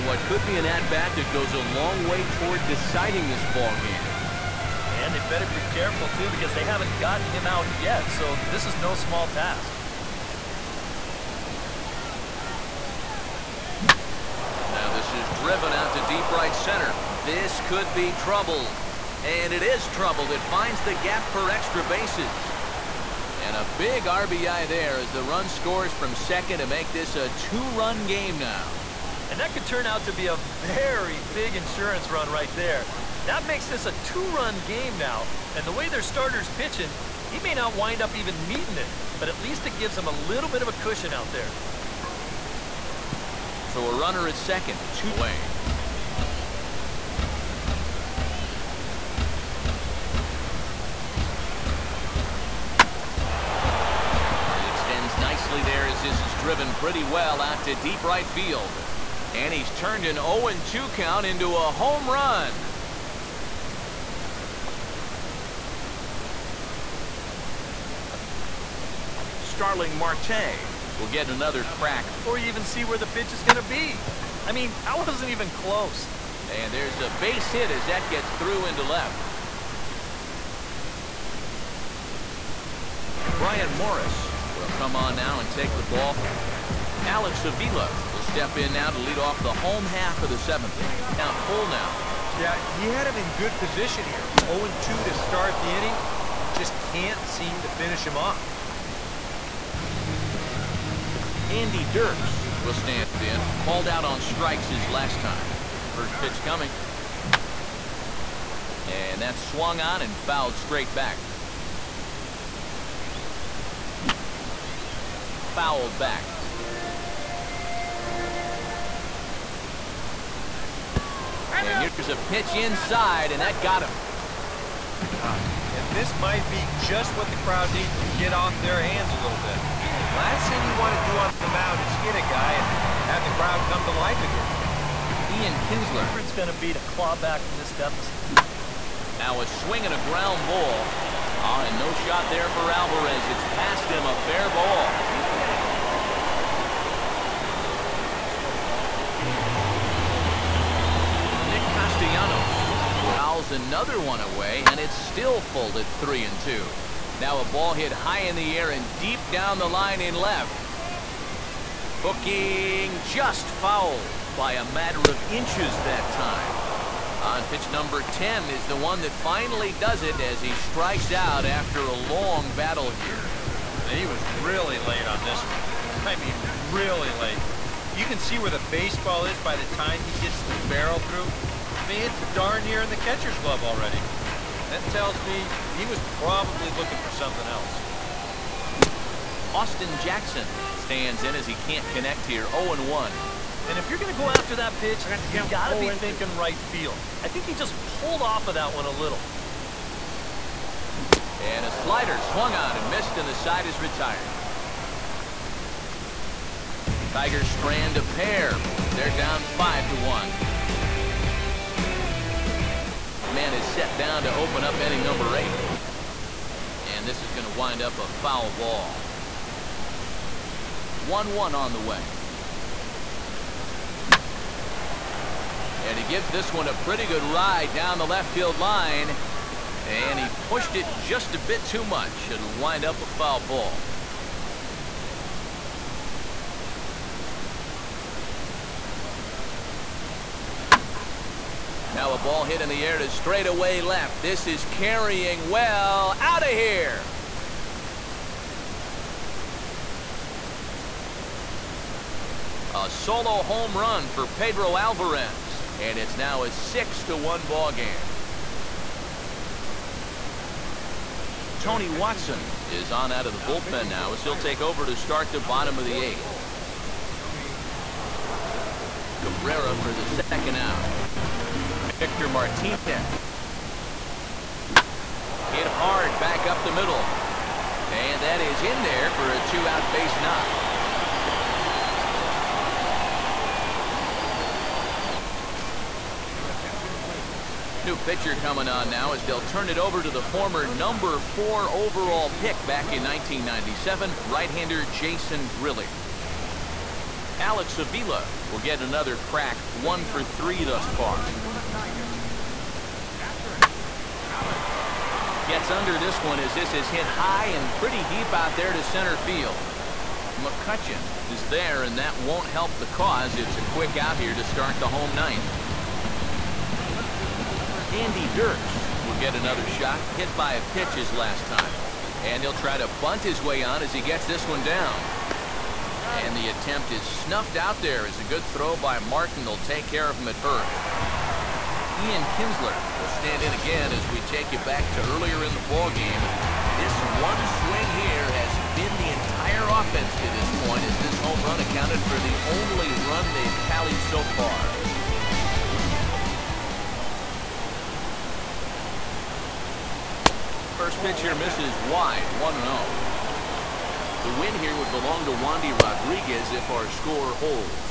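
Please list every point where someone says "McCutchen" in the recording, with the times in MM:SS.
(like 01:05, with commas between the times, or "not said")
05:10.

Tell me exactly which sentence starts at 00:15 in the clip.
is driven out to deep right center.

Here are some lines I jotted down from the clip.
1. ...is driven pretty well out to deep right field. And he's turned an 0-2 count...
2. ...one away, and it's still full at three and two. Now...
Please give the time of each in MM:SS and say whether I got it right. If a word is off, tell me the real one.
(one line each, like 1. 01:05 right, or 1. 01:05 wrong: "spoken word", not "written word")
1. 00:56 right
2. 02:33 right.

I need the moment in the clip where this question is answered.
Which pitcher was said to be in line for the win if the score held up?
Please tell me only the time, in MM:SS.
05:55.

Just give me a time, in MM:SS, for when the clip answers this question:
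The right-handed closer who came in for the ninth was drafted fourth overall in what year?
04:53.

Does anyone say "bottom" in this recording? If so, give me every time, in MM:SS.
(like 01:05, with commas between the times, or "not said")
04:25.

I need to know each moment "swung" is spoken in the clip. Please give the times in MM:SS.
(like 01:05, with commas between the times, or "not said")
01:49, 03:22.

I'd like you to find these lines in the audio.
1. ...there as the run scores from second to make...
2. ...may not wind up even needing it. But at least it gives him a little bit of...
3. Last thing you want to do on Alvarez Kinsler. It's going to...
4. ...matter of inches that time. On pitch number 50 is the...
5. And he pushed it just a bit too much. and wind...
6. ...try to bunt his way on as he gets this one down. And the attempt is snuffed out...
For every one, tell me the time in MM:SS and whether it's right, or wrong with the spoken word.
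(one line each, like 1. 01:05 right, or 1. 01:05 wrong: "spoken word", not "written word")
1. 00:24 right
2. 00:37 right
3. 02:10 wrong: "Ian", not "Alvarez"
4. 02:44 wrong: "10", not "50"
5. 03:49 right
6. 05:22 right.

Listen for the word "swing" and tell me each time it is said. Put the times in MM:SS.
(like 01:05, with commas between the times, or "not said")
02:19, 05:37.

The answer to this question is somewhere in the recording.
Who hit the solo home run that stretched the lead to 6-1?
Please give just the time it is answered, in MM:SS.
04:14.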